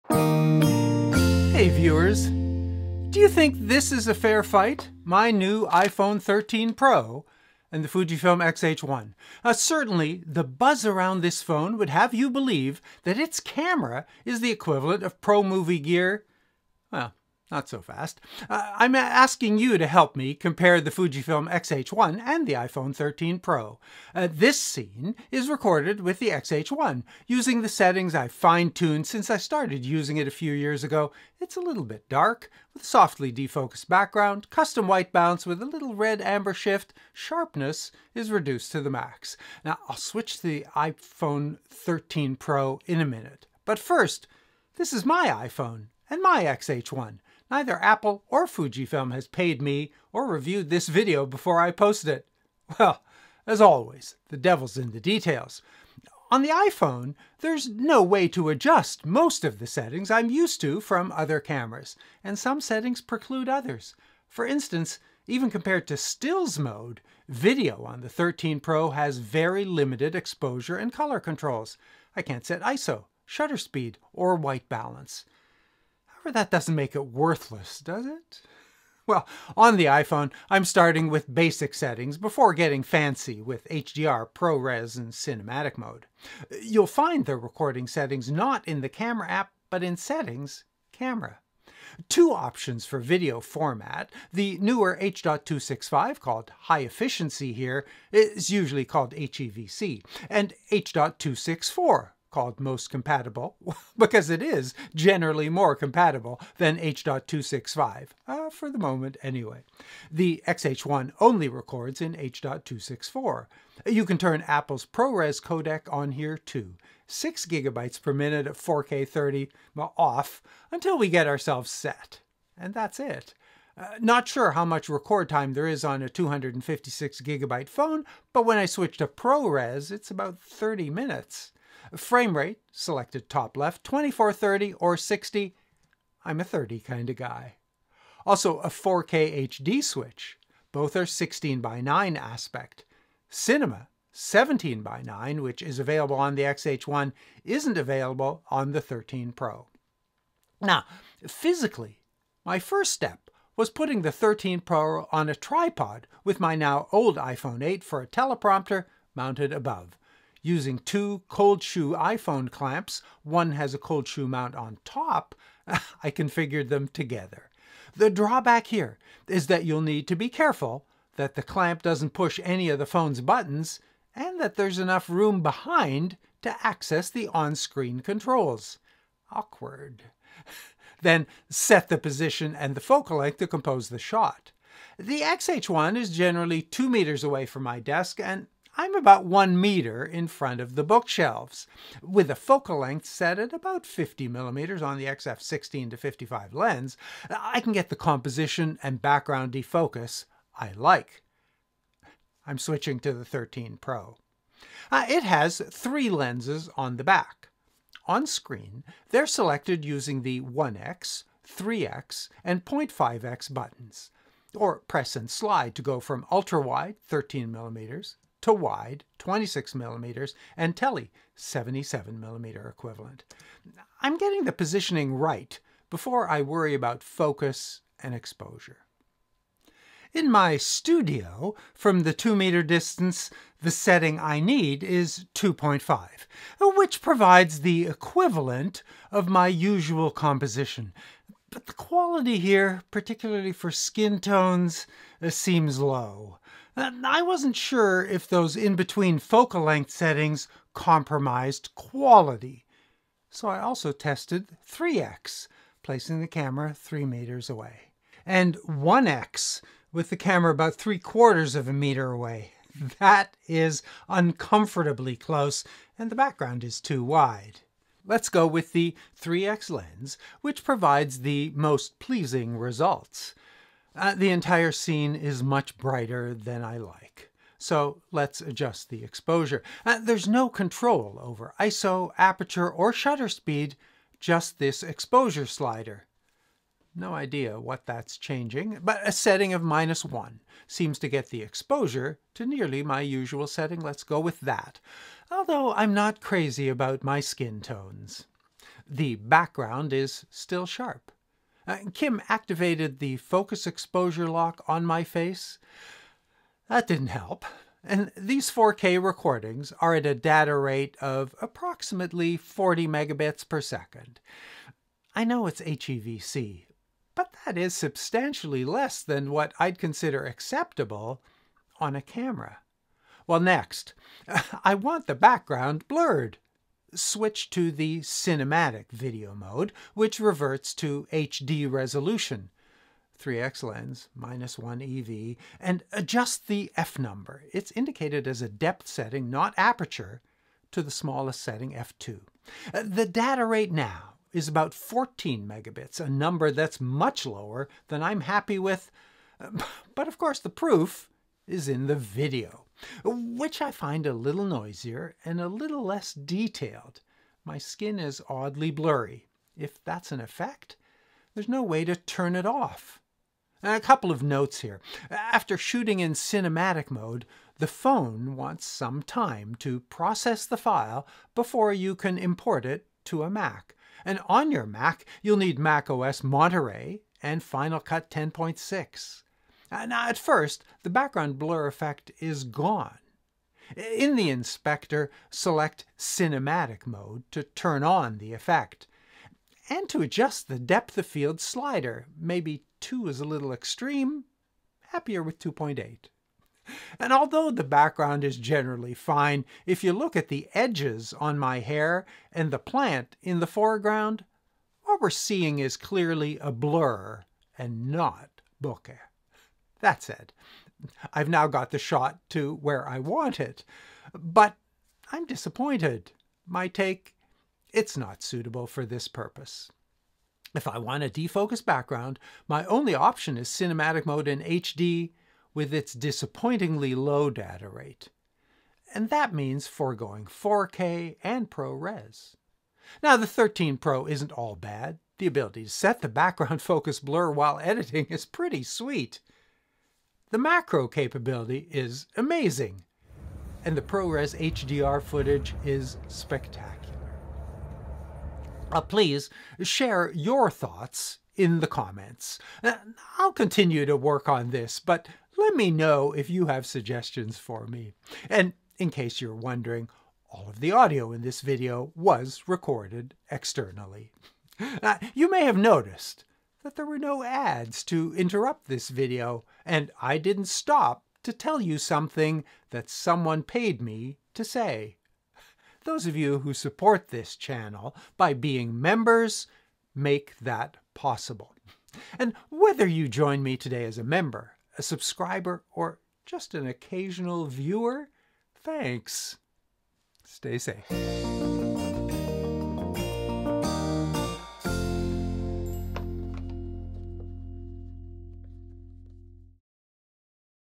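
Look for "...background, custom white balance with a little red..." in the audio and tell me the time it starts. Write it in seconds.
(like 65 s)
33 s.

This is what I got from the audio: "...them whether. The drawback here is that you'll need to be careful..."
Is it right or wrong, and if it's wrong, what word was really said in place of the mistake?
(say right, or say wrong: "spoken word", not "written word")
wrong: "together", not "whether".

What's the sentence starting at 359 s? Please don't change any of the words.
If that's an effect, there's no way to turn it off.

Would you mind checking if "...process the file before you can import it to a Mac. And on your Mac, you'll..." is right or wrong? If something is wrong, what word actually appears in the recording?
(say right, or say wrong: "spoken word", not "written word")
right.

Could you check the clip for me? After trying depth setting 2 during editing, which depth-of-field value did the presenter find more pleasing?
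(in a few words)
2.8.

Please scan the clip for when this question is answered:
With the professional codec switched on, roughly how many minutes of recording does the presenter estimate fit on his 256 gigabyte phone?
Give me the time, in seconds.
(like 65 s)
130 s.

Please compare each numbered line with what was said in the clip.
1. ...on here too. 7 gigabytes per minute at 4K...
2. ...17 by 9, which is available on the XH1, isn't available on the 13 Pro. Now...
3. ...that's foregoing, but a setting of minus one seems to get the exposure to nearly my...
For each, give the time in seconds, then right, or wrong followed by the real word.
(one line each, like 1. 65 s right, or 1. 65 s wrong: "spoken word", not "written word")
1. 115 s wrong: "6", not "7"
2. 144 s right
3. 287 s wrong: "changing", not "foregoing".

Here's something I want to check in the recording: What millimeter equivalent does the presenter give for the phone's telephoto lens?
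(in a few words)
77 millimeter.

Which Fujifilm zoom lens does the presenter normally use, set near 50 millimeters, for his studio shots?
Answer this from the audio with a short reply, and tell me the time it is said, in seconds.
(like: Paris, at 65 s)
XF 16 to 55, at 195 s.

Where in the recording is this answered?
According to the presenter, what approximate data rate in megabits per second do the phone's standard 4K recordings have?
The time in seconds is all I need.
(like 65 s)
312 s.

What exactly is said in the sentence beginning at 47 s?
Neither Apple or Fujifilm has paid me or reviewed this video before I posted it.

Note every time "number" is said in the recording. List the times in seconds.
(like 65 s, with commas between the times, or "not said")
336 s, 346 s.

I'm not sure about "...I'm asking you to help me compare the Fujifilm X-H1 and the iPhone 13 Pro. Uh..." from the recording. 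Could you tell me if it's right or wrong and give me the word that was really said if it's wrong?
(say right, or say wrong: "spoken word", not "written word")
right.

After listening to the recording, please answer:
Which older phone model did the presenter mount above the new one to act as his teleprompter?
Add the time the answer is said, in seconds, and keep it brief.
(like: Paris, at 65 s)
iPhone 8, at 157 s.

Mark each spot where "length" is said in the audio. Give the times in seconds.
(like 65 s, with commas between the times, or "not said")
183 s, 192 s, 249 s.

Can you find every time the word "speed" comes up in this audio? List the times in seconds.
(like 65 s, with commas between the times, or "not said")
73 s, 283 s.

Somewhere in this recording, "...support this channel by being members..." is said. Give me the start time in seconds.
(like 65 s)
476 s.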